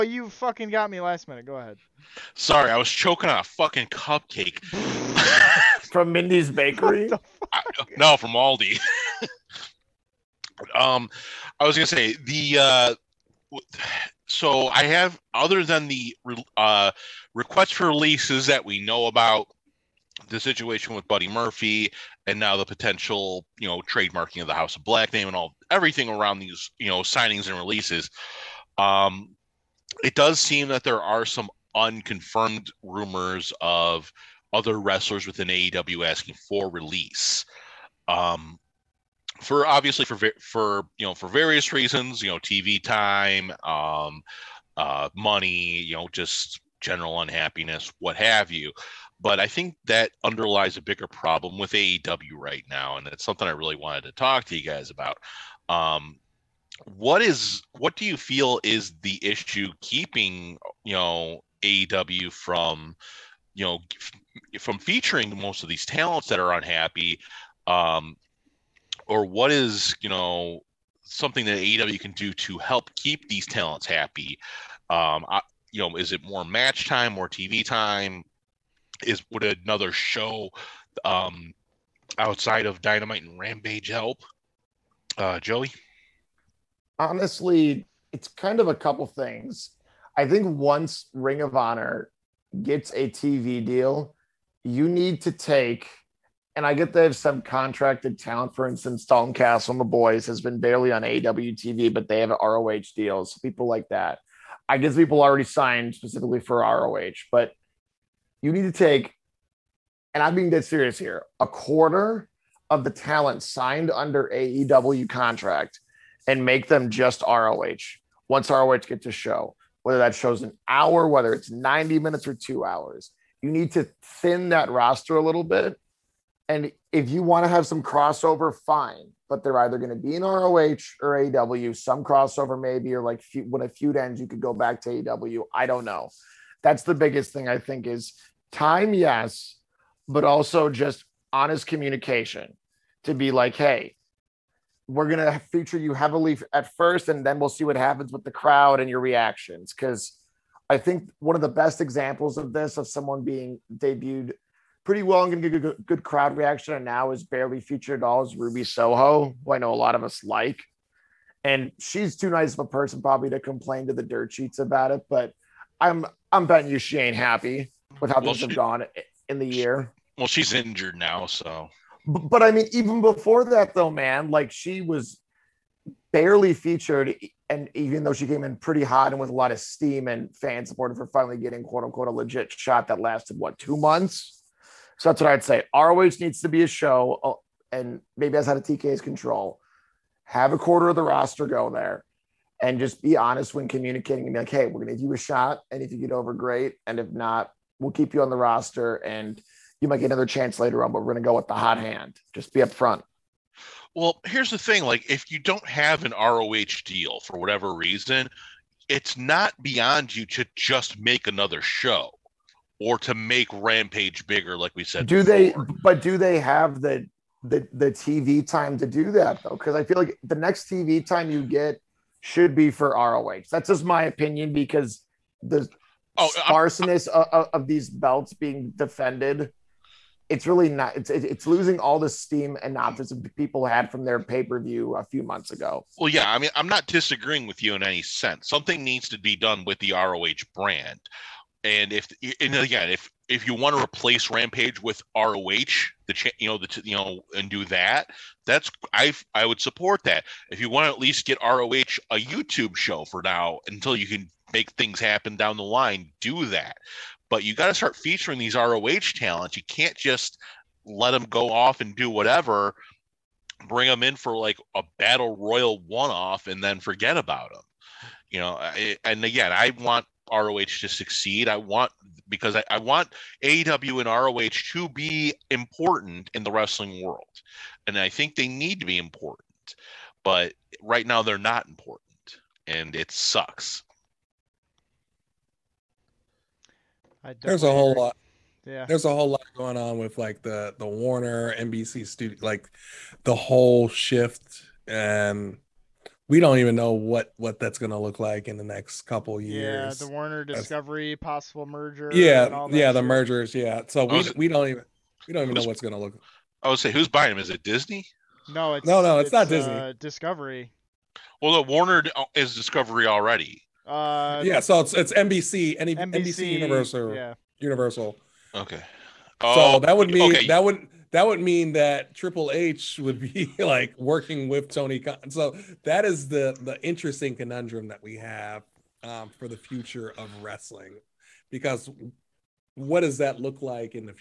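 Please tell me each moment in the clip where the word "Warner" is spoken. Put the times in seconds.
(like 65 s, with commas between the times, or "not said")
290 s, 300 s, 311 s.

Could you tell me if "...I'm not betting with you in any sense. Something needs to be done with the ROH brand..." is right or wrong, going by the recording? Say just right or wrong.
wrong.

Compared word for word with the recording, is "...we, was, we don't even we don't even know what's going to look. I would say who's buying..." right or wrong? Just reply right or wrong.
right.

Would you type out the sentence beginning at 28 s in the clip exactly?
Um, it does seem that there are some unconfirmed rumors of other wrestlers within AEW asking for release.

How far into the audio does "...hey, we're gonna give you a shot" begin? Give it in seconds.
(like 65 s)
194 s.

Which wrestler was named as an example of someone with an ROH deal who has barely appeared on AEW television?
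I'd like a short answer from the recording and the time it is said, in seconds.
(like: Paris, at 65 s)
Dalton Castle, at 99 s.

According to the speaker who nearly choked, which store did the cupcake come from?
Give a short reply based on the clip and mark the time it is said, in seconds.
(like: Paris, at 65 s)
Aldi, at 8 s.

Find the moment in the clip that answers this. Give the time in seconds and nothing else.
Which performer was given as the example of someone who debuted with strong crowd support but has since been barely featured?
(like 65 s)
158 s.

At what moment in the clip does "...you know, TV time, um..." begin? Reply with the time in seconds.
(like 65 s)
42 s.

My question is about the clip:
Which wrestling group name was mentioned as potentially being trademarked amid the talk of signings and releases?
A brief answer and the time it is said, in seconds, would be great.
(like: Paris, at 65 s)
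House of Black, at 24 s.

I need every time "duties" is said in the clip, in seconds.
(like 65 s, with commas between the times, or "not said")
not said.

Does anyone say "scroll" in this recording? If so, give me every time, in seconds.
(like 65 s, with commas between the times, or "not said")
not said.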